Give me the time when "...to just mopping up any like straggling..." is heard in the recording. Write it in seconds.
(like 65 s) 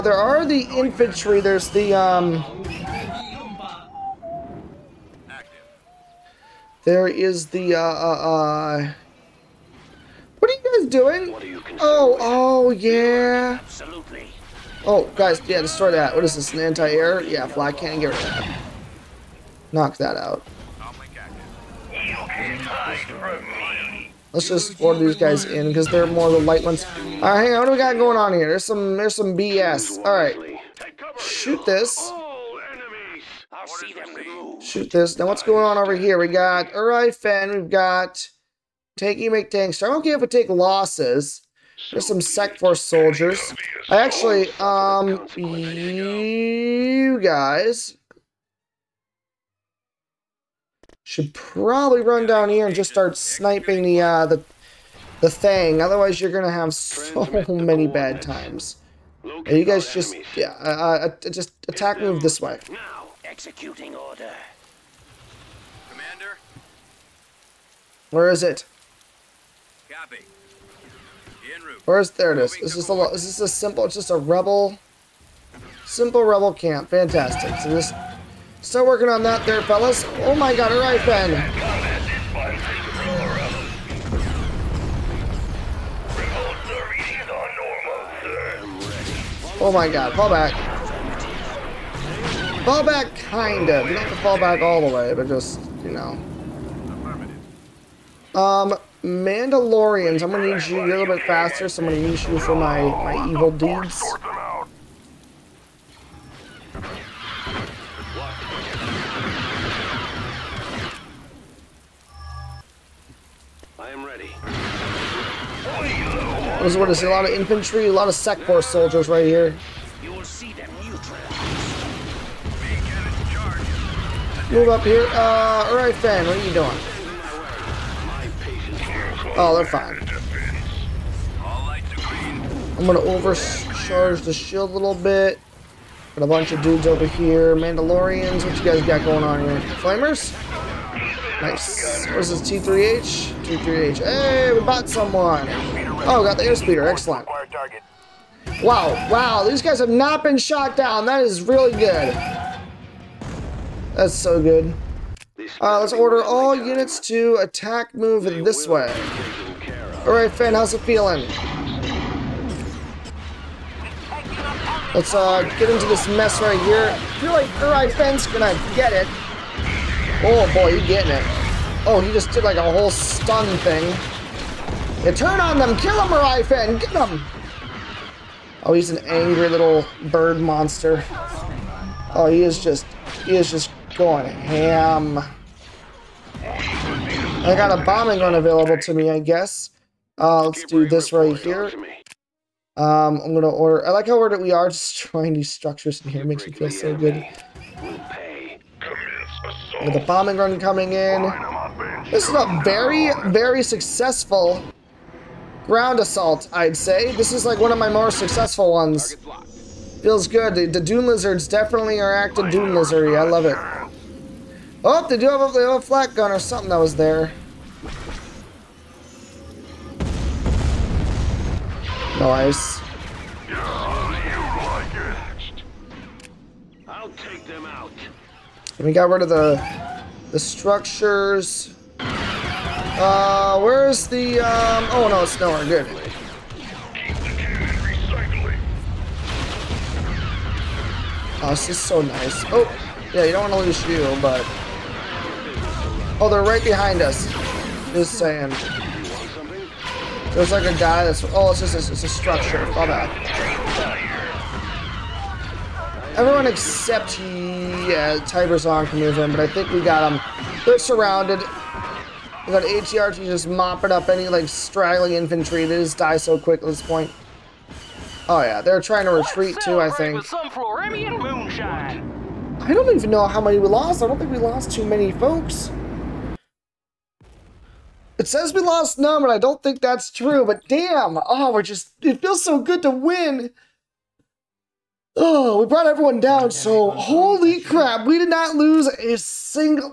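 262 s.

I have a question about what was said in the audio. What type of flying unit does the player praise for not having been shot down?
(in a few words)
Airspeeder.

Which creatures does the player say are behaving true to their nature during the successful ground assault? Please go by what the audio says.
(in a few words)
Dune Lizards.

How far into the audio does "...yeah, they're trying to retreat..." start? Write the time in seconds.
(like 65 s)
268 s.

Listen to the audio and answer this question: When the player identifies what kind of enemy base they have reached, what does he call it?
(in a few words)
Simple rebel camp.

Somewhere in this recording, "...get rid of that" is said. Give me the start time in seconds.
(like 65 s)
17 s.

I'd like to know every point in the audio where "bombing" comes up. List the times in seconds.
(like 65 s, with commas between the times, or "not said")
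187 s, 200 s.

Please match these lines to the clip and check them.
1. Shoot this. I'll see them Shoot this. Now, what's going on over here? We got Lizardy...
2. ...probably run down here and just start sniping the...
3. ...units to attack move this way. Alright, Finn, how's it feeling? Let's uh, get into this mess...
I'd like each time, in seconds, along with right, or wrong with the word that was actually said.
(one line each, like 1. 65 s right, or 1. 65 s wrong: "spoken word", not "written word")
1. 31 s wrong: "Alright", not "Lizardy"
2. 51 s right
3. 156 s right.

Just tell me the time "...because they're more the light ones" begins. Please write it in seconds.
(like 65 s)
25 s.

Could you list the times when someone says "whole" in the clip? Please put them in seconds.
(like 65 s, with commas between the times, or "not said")
172 s.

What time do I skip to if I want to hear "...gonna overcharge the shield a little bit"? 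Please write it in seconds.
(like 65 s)
132 s.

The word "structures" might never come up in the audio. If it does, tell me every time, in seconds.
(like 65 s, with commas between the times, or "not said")
195 s, 230 s, 252 s.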